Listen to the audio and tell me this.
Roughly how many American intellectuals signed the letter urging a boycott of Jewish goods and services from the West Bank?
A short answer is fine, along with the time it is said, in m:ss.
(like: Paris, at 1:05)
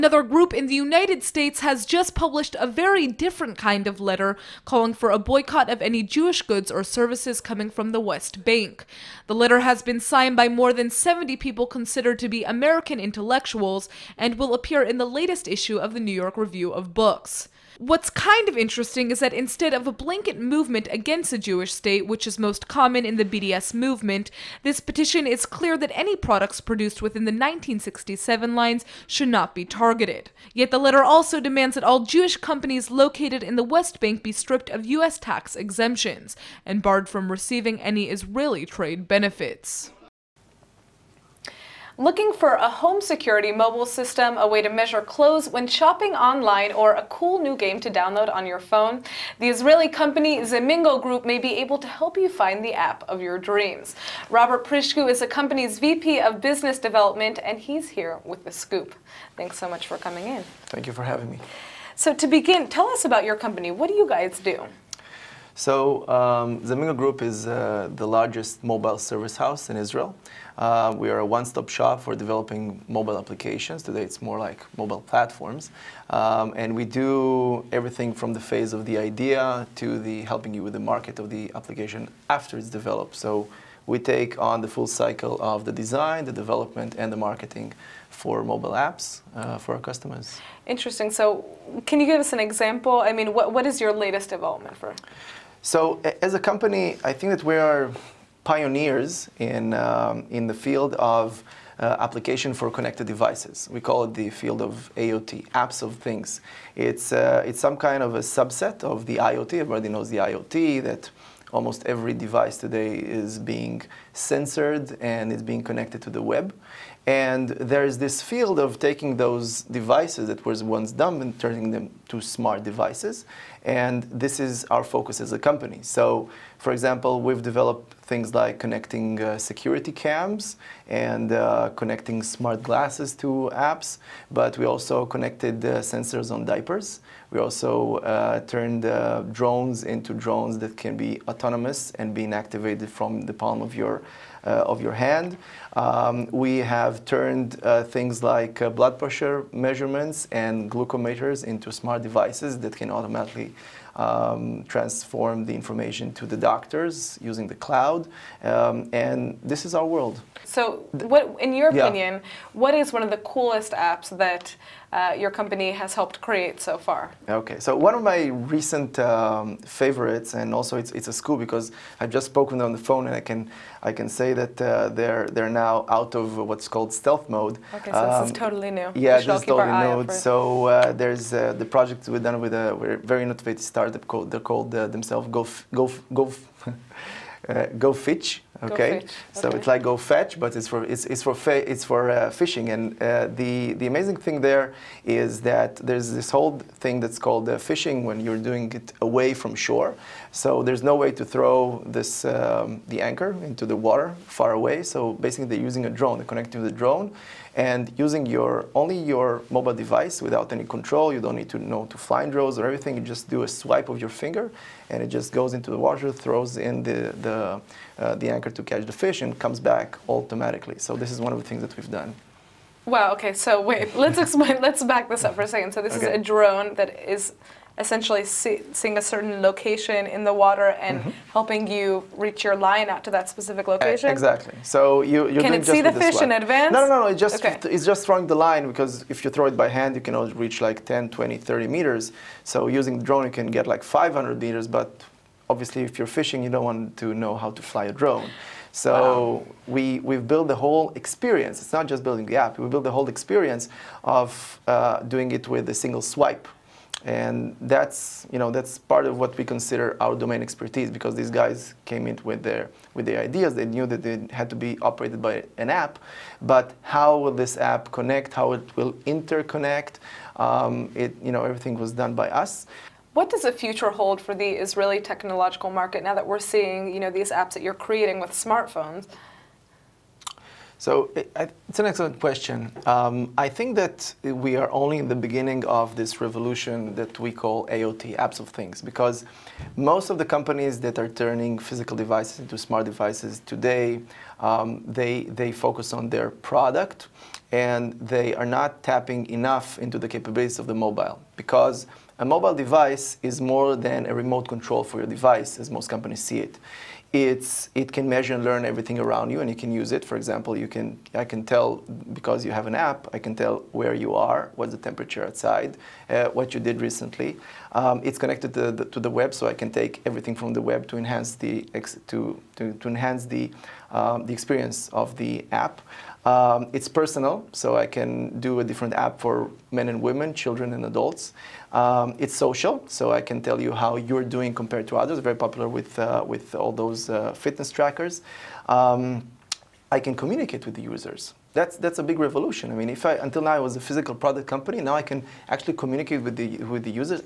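more than 70, at 0:10.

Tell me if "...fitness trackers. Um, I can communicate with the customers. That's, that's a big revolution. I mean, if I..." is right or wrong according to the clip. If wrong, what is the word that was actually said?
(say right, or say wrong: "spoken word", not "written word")
wrong: "users", not "customers".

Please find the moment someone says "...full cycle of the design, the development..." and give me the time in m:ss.
1:24.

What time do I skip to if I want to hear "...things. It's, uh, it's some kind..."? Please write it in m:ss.
1:45.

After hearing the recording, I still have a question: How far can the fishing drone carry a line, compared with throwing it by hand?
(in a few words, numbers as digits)
500 meters.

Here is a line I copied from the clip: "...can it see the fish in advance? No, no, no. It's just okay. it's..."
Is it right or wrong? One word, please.
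right.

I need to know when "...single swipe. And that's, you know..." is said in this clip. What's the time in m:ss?
4:15.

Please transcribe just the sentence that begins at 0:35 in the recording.
tax exemptions and barred from receiving any Israeli trade benefits.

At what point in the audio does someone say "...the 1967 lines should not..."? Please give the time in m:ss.
0:27.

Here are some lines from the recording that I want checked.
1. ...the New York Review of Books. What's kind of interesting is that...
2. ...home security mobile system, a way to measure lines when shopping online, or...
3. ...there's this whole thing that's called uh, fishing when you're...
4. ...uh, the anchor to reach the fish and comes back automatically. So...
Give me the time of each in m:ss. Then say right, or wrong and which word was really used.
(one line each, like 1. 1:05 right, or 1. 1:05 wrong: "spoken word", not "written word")
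1. 0:15 right
2. 0:42 wrong: "clothes", not "lines"
3. 3:15 right
4. 3:37 wrong: "catch", not "reach".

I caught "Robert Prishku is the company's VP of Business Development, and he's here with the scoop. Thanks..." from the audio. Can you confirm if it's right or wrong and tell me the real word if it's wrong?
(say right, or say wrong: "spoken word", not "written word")
right.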